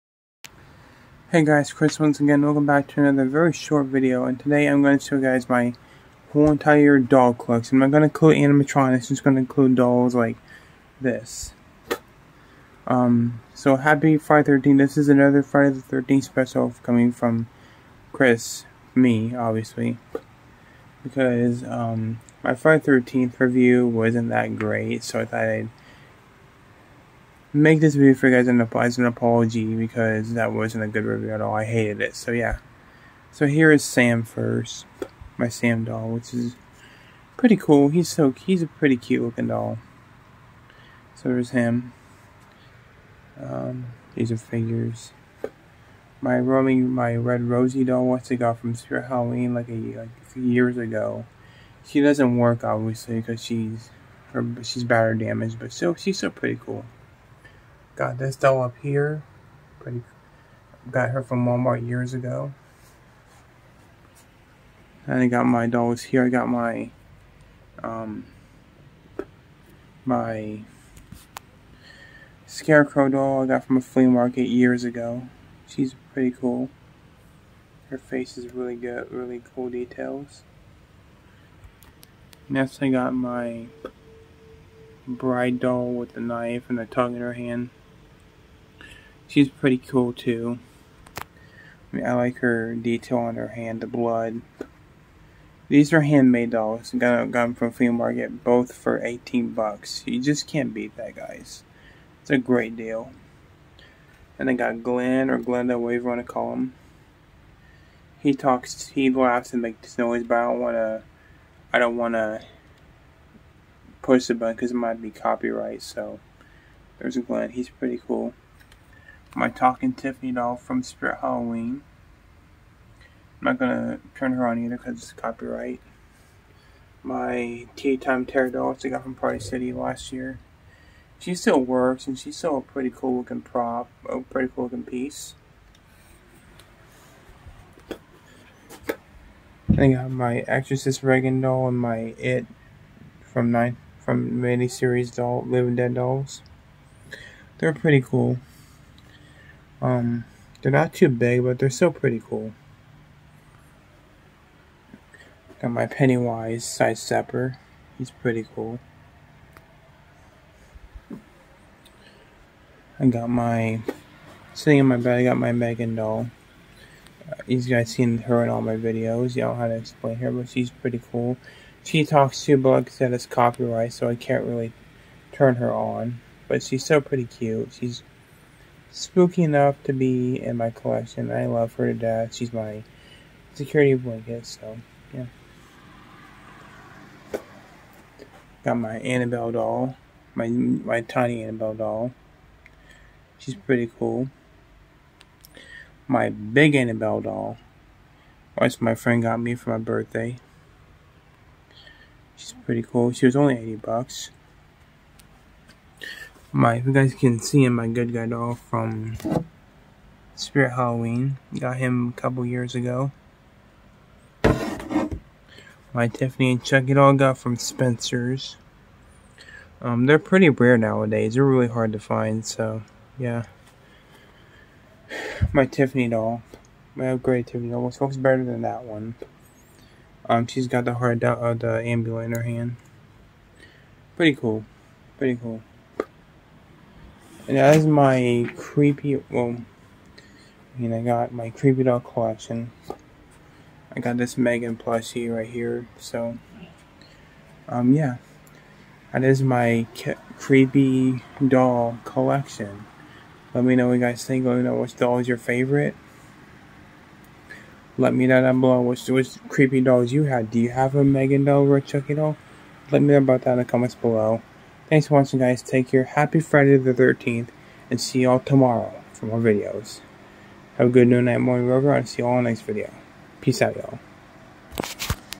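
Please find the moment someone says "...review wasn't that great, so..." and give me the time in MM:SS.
00:23.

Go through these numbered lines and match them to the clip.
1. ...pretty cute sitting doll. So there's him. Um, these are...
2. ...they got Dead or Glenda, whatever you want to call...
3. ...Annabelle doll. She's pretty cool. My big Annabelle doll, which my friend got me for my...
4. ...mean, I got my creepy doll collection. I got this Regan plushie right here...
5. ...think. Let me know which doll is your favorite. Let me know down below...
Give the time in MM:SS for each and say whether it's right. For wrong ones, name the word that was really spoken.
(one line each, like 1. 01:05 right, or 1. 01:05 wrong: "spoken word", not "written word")
1. 00:38 wrong: "looking", not "sitting"
2. 01:44 wrong: "Glen", not "Dead"
3. 03:11 right
4. 04:00 wrong: "Megan", not "Regan"
5. 04:14 right.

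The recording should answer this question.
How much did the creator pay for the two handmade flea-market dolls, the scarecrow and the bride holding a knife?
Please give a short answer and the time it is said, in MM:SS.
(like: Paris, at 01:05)
$18, at 01:39.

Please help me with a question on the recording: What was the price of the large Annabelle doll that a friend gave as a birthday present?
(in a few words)
$80.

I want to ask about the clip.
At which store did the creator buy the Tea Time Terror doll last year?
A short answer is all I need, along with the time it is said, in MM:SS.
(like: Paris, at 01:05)
Party City, at 02:09.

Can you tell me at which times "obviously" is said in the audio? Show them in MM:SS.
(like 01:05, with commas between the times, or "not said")
00:19, 00:52.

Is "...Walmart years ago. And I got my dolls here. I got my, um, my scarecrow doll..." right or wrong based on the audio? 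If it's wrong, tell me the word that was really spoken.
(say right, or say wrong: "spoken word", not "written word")
right.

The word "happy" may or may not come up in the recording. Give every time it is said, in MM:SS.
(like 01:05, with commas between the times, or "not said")
00:13, 04:26.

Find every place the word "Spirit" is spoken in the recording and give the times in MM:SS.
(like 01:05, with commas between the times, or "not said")
00:48, 02:00, 03:30.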